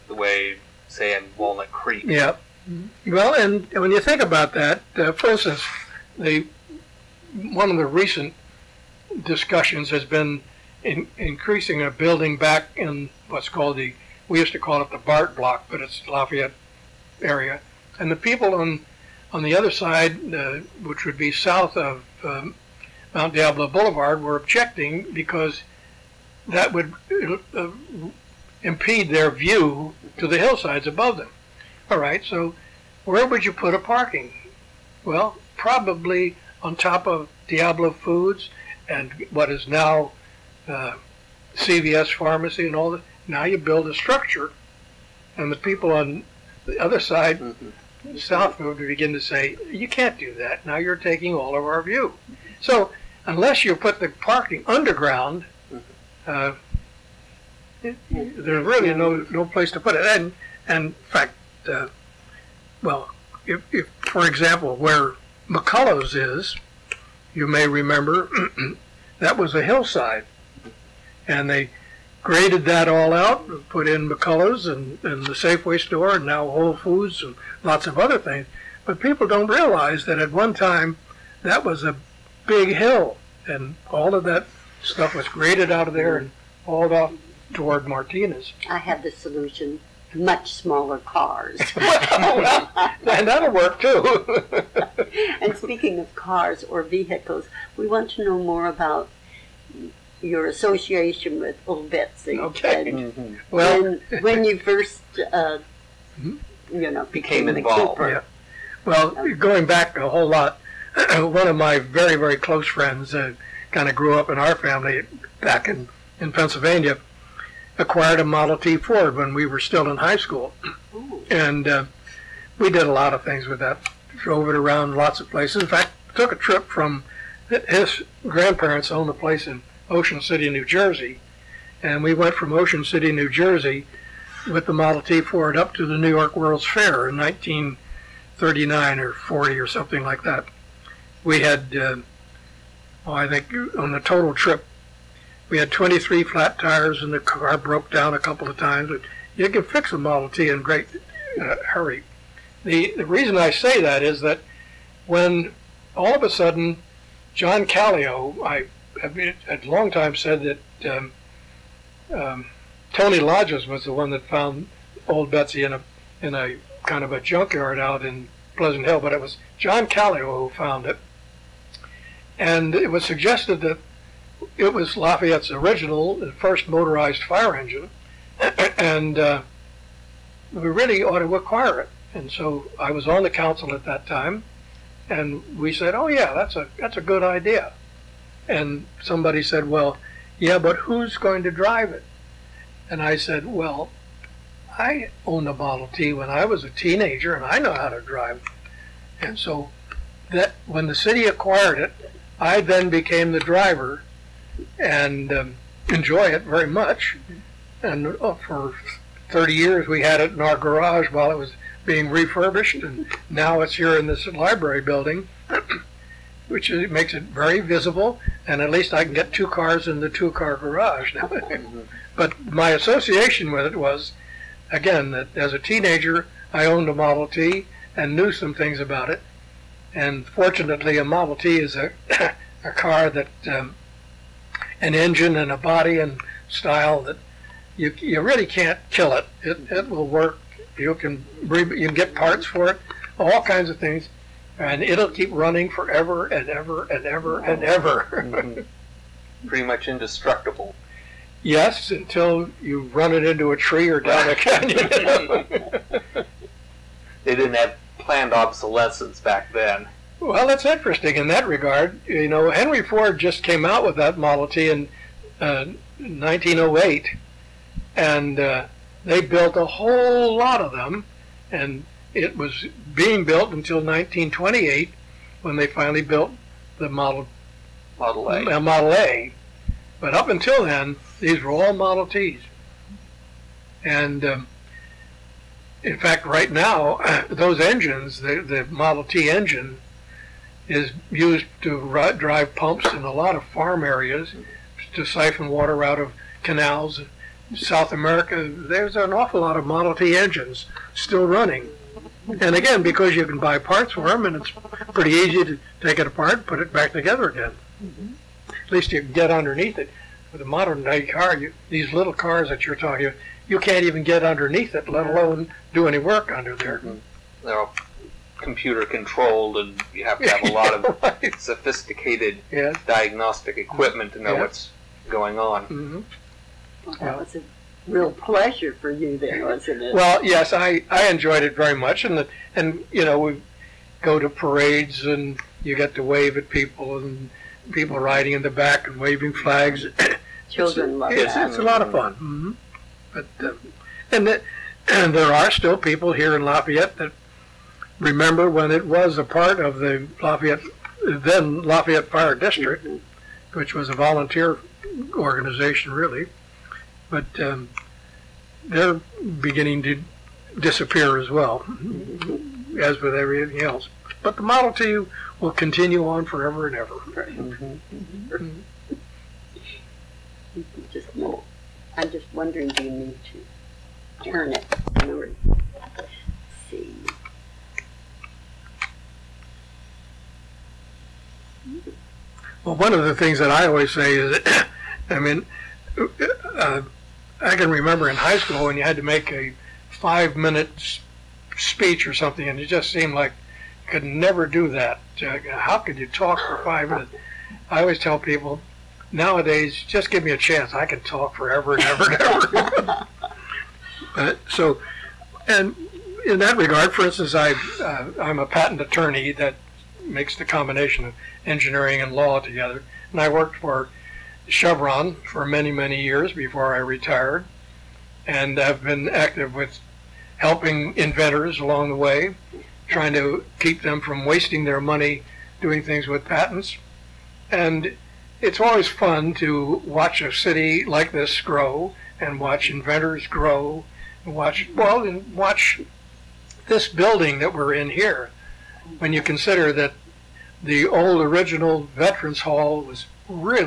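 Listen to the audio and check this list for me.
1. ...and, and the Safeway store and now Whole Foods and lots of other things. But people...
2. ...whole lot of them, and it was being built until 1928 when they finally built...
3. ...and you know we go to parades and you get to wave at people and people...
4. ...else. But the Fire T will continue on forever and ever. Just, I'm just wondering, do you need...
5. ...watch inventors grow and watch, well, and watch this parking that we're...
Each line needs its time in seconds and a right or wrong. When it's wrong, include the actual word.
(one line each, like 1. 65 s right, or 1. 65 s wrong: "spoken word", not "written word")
1. 74 s right
2. 269 s right
3. 332 s right
4. 363 s wrong: "Model", not "Fire"
5. 432 s wrong: "building", not "parking".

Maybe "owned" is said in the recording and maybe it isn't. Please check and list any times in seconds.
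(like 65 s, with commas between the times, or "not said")
128 s, 195 s, 226 s.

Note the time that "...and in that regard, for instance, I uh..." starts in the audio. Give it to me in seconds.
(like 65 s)
405 s.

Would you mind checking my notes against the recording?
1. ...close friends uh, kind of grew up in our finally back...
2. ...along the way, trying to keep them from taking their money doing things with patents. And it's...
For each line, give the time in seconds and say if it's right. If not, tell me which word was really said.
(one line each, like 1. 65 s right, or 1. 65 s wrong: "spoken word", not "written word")
1. 112 s wrong: "family", not "finally"
2. 421 s wrong: "wasting", not "taking".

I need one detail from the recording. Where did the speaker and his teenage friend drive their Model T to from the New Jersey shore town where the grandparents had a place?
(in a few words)
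New York World's Fair.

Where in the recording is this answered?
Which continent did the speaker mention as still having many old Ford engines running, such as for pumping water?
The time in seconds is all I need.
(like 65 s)
297 s.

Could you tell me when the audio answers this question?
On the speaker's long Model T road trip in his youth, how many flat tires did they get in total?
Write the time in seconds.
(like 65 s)
145 s.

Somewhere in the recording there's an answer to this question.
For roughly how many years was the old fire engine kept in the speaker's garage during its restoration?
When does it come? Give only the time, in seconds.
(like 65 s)
209 s.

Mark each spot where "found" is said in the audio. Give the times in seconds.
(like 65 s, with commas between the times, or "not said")
164 s, 170 s.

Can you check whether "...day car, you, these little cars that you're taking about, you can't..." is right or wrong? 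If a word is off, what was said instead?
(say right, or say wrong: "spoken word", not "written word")
wrong: "talking", not "taking".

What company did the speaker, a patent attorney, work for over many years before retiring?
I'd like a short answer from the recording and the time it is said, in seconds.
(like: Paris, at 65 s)
Chevron, at 414 s.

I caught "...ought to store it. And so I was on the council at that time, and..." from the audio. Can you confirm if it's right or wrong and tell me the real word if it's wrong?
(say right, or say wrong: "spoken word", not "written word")
wrong: "acquire", not "store".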